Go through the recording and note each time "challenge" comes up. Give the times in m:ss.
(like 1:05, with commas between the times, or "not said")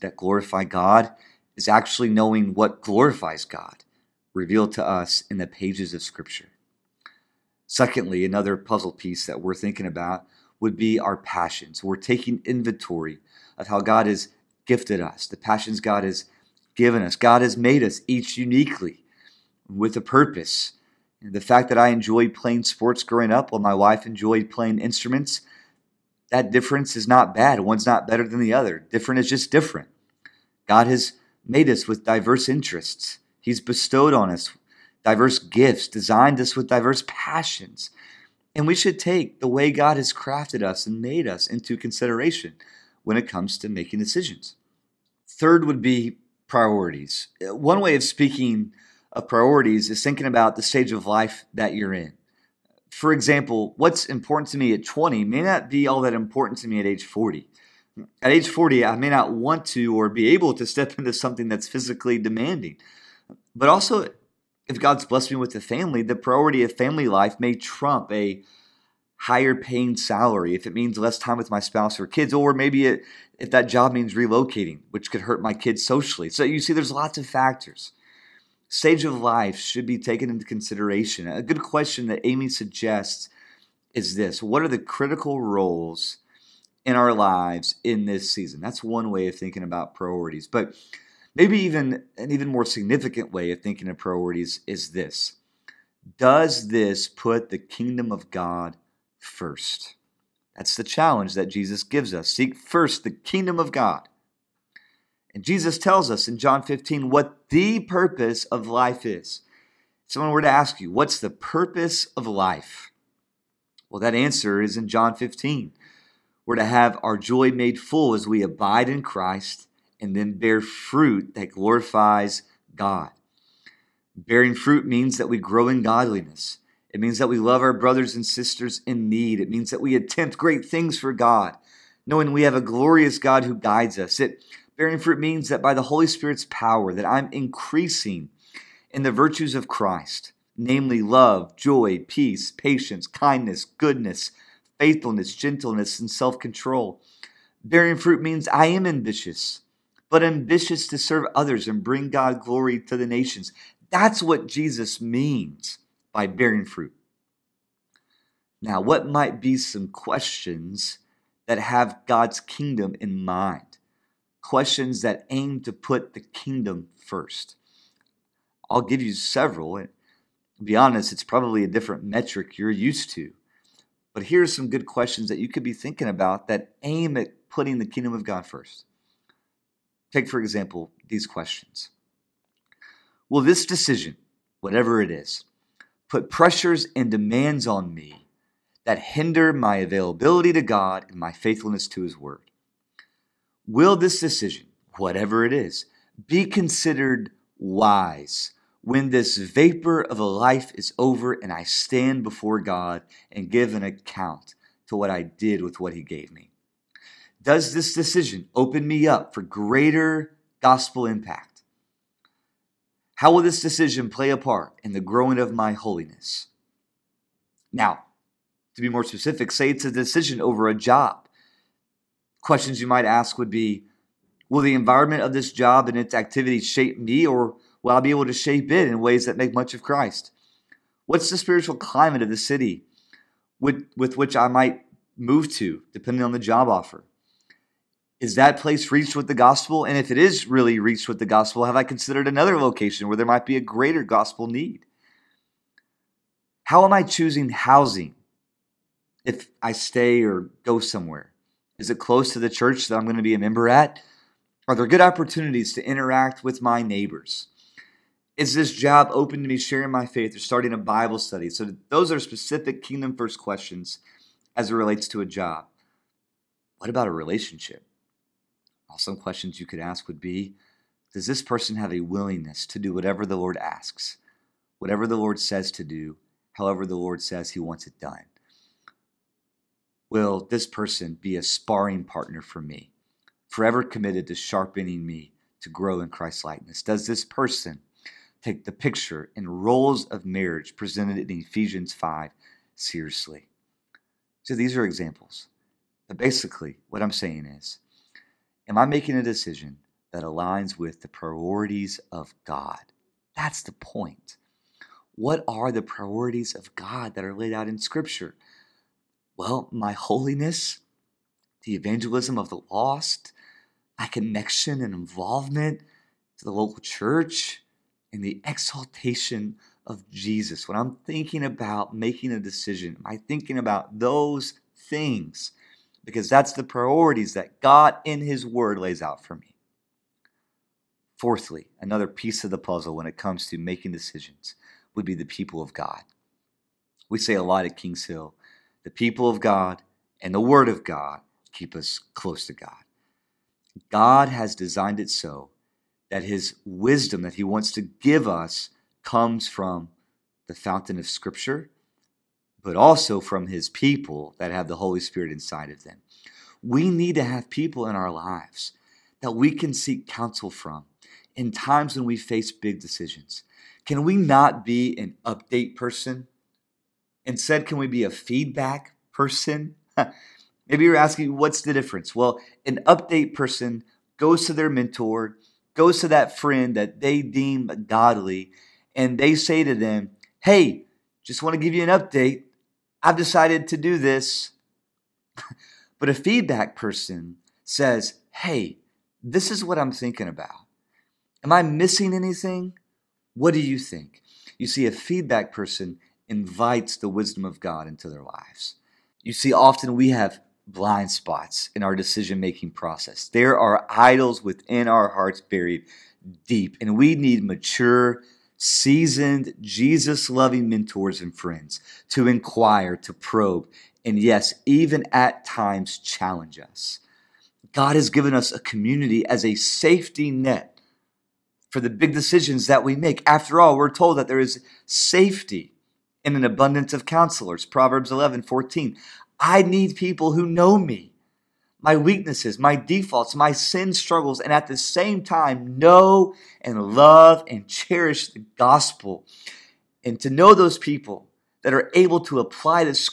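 1:40, 6:55.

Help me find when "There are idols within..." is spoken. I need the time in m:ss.
6:43.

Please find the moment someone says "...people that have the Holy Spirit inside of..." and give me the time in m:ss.
5:53.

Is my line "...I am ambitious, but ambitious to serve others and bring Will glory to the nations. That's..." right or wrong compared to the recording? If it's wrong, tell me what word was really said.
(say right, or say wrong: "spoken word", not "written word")
wrong: "God", not "Will".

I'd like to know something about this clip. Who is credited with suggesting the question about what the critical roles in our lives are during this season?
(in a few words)
Amy.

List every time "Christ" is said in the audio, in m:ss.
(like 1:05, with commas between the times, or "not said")
1:59, 2:19, 3:49, 4:46.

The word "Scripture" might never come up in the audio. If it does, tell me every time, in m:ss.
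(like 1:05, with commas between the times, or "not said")
0:06, 5:07, 5:51.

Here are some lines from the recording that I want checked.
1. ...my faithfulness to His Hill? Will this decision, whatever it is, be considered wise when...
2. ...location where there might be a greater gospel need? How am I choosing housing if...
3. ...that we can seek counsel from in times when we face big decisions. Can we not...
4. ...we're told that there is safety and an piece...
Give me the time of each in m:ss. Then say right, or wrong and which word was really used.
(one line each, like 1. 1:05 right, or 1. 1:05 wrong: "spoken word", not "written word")
1. 3:11 wrong: "Word", not "Hill"
2. 4:02 right
3. 5:59 right
4. 7:03 wrong: "abundance", not "piece".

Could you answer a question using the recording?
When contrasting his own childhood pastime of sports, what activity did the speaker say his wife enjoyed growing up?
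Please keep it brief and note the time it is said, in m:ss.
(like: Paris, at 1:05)
Playing instruments, at 0:24.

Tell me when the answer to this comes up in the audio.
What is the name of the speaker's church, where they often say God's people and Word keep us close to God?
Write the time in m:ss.
5:37.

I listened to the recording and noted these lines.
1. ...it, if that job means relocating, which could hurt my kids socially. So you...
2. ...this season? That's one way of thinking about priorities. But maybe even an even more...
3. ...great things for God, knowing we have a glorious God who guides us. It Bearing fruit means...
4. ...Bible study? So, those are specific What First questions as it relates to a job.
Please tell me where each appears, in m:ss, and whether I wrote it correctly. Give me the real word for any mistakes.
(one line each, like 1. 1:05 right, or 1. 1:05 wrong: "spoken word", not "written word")
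1. 1:12 right
2. 1:28 right
3. 2:10 right
4. 4:20 wrong: "Kingdom", not "What".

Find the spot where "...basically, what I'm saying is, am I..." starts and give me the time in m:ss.
4:56.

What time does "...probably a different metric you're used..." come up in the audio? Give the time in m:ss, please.
2:51.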